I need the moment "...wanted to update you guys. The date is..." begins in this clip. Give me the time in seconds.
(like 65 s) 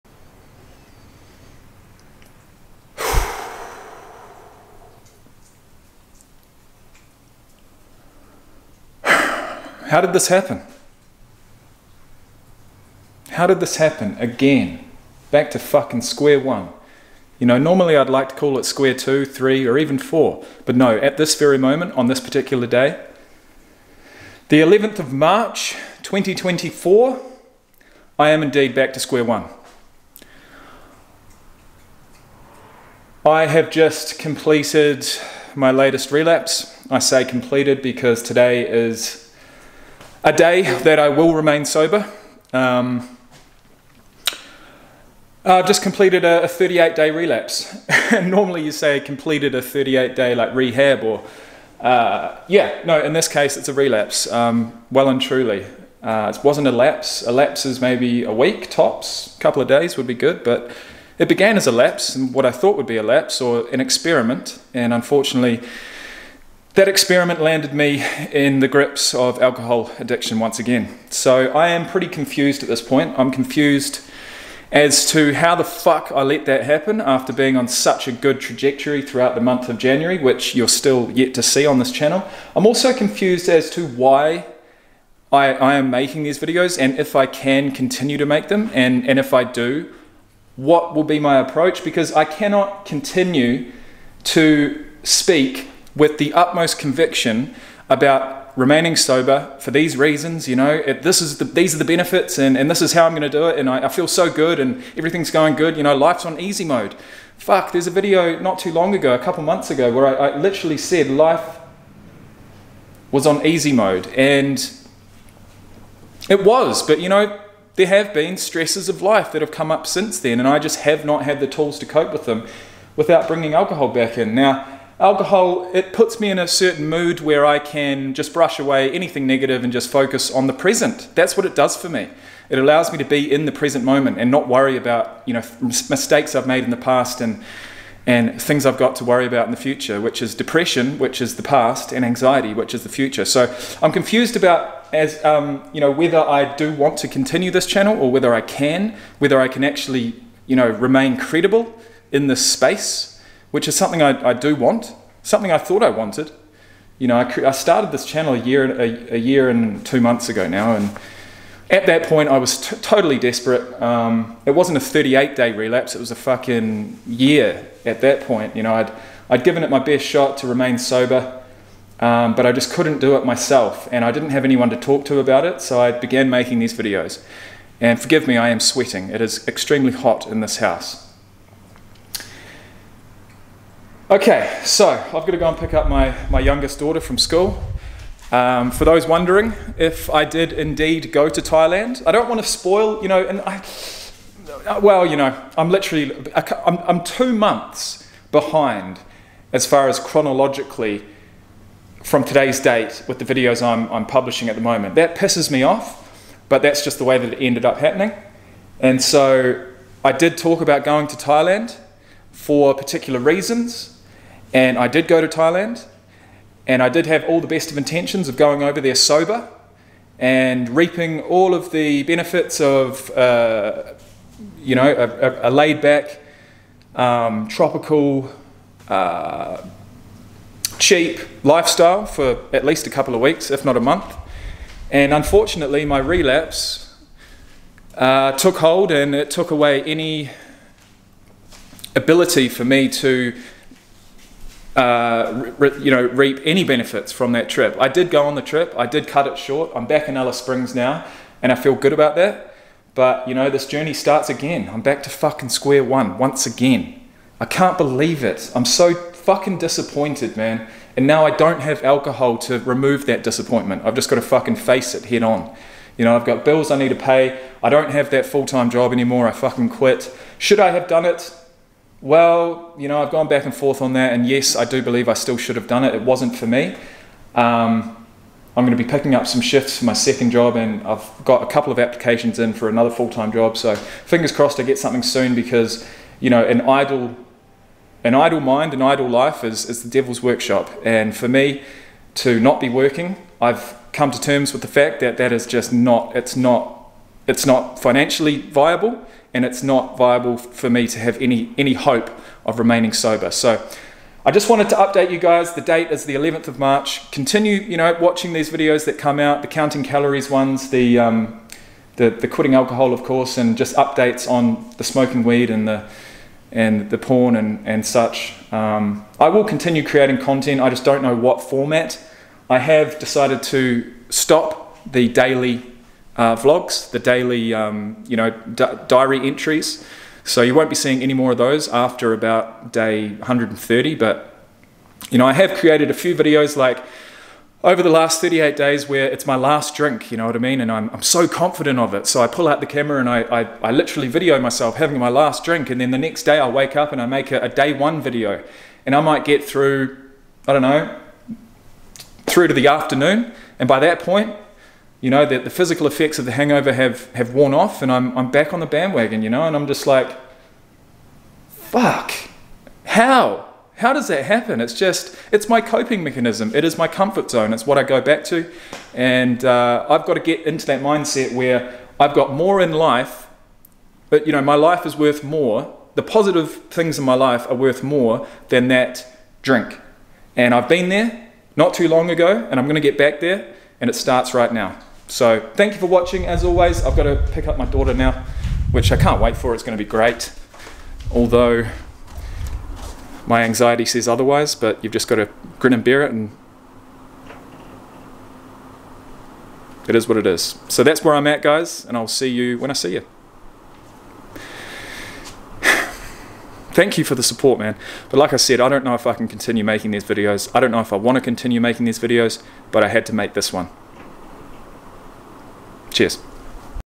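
304 s.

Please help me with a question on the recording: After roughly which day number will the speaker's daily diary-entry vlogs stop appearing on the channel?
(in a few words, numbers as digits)
Day 130.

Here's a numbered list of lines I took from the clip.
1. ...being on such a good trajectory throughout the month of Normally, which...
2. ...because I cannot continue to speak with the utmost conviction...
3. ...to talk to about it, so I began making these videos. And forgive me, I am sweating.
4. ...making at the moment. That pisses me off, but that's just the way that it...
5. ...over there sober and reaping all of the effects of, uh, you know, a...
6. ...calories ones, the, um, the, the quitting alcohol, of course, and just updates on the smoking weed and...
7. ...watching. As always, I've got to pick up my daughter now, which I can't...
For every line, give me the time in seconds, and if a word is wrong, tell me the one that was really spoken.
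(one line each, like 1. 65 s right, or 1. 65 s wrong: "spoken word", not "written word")
1. 77 s wrong: "January", not "Normally"
2. 91 s right
3. 174 s right
4. 204 s wrong: "publishing", not "making"
5. 218 s wrong: "benefits", not "effects"
6. 309 s right
7. 385 s right.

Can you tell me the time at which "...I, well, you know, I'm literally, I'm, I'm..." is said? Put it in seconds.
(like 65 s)
193 s.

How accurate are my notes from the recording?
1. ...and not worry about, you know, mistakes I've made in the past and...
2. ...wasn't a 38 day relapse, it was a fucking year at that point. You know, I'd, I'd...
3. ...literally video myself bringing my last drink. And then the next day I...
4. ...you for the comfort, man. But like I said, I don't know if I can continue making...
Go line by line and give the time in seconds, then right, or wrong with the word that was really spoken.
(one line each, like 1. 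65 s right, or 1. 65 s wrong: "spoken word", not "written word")
1. 134 s right
2. 164 s right
3. 343 s wrong: "having", not "bringing"
4. 406 s wrong: "support", not "comfort".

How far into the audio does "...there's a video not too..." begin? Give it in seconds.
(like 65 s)
107 s.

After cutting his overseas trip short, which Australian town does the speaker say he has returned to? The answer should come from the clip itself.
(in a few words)
Alice Springs.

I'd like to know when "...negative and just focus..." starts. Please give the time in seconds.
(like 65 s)
129 s.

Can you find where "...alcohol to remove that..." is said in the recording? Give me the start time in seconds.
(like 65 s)
261 s.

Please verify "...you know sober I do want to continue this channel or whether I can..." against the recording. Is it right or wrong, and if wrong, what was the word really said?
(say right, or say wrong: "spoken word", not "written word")
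wrong: "whether", not "sober".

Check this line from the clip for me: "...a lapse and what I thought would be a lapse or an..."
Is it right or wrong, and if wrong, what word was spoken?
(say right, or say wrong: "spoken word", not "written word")
right.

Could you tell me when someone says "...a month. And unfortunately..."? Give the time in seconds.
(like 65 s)
233 s.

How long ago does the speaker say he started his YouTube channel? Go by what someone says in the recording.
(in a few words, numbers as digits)
A year and two months.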